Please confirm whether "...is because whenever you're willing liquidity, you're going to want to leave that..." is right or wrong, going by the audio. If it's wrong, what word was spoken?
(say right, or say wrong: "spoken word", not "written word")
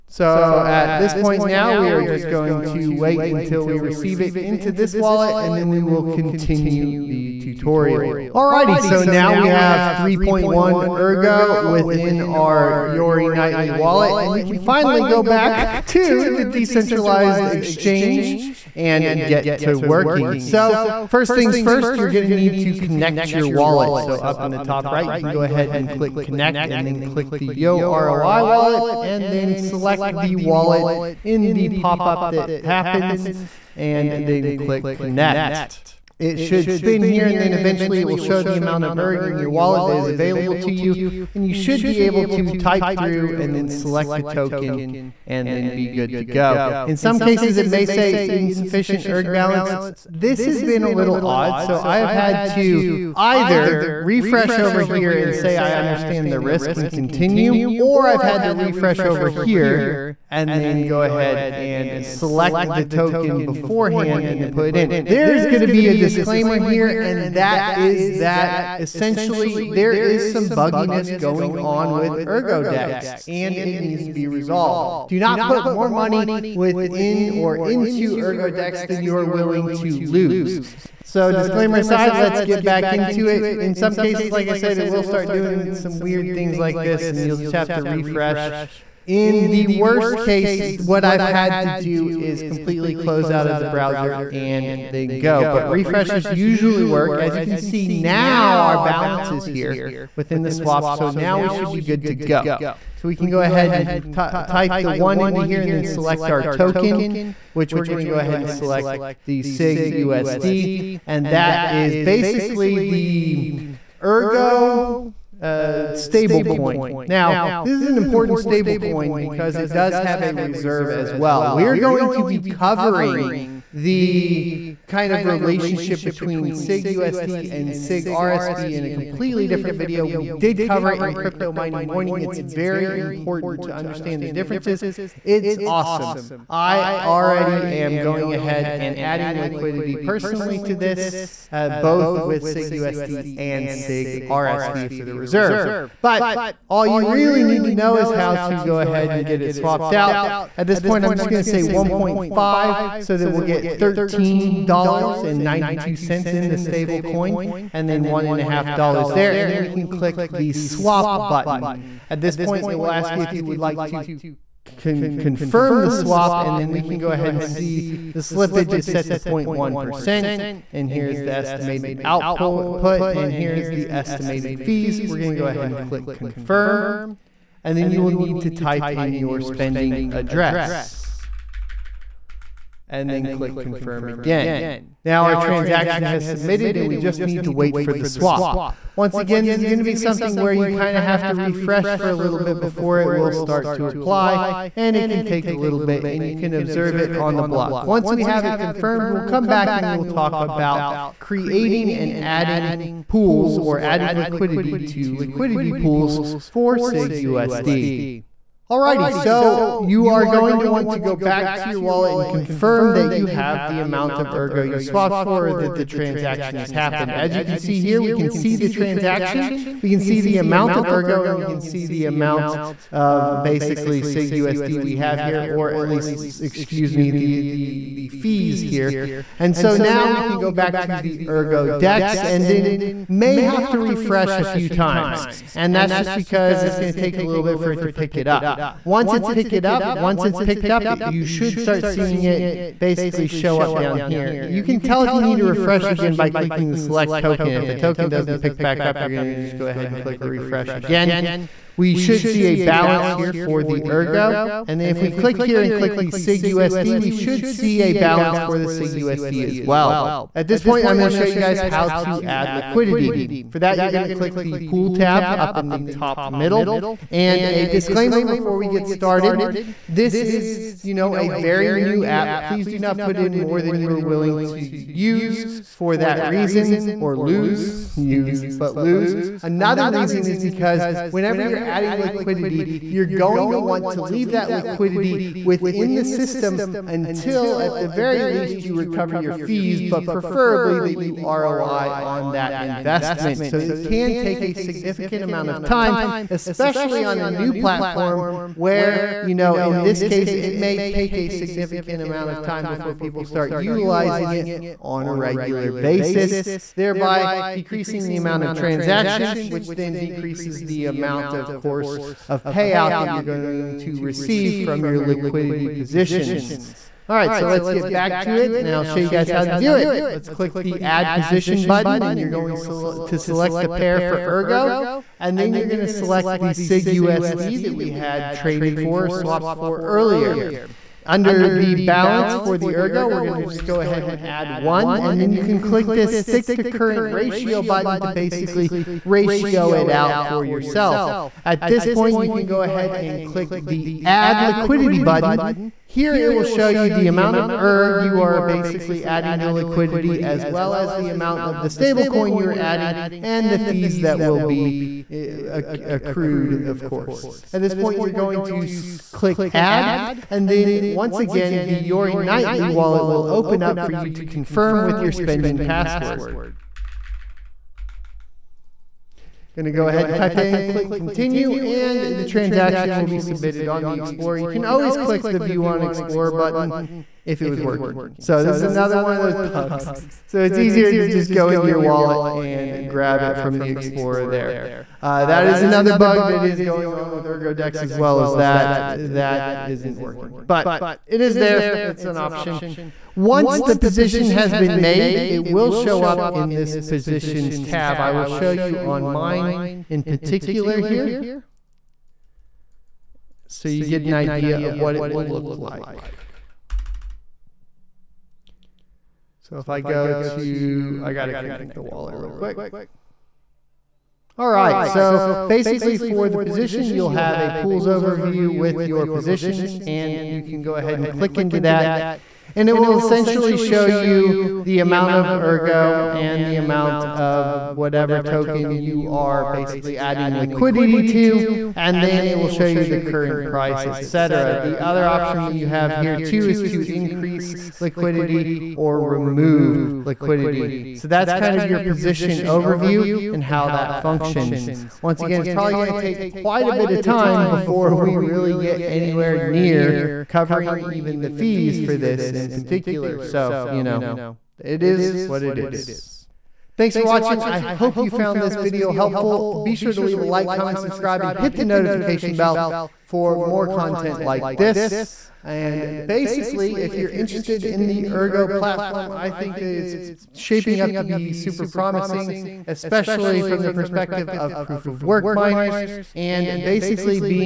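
wrong: "adding", not "willing".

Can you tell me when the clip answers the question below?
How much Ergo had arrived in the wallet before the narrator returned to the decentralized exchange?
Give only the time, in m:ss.
0:09.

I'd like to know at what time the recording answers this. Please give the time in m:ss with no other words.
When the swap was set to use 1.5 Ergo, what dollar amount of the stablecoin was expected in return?
2:33.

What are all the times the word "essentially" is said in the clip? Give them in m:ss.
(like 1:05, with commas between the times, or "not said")
1:08, 7:02.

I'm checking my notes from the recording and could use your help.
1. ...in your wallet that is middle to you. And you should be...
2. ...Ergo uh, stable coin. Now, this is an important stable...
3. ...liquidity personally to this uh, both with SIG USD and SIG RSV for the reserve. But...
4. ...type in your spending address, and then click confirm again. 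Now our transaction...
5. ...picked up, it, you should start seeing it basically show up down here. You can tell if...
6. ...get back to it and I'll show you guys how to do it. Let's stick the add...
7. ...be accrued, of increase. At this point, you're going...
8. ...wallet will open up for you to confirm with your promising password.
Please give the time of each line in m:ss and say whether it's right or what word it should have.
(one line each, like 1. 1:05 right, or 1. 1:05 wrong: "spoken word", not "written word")
1. 0:39 wrong: "available", not "middle"
2. 1:54 right
3. 2:19 right
4. 2:58 right
5. 4:00 right
6. 5:17 wrong: "click", not "stick"
7. 5:54 wrong: "course", not "increase"
8. 6:02 wrong: "spending", not "promising".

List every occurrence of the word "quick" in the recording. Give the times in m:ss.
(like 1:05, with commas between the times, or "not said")
6:52.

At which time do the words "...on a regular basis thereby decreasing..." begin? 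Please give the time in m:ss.
5:04.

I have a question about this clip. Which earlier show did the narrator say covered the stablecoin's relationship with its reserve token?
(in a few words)
Crypto Mining Morning.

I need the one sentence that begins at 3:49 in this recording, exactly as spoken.
And so now we can go back to the Ergo DEX and then may have to refresh a few times.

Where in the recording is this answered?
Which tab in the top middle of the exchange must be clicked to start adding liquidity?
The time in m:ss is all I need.
4:24.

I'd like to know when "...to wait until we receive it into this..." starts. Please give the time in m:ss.
0:02.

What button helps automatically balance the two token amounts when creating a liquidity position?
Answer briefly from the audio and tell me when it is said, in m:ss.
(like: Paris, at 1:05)
stick to current ratio, at 5:36.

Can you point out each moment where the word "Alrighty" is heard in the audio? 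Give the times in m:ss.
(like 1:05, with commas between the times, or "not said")
0:08, 3:28.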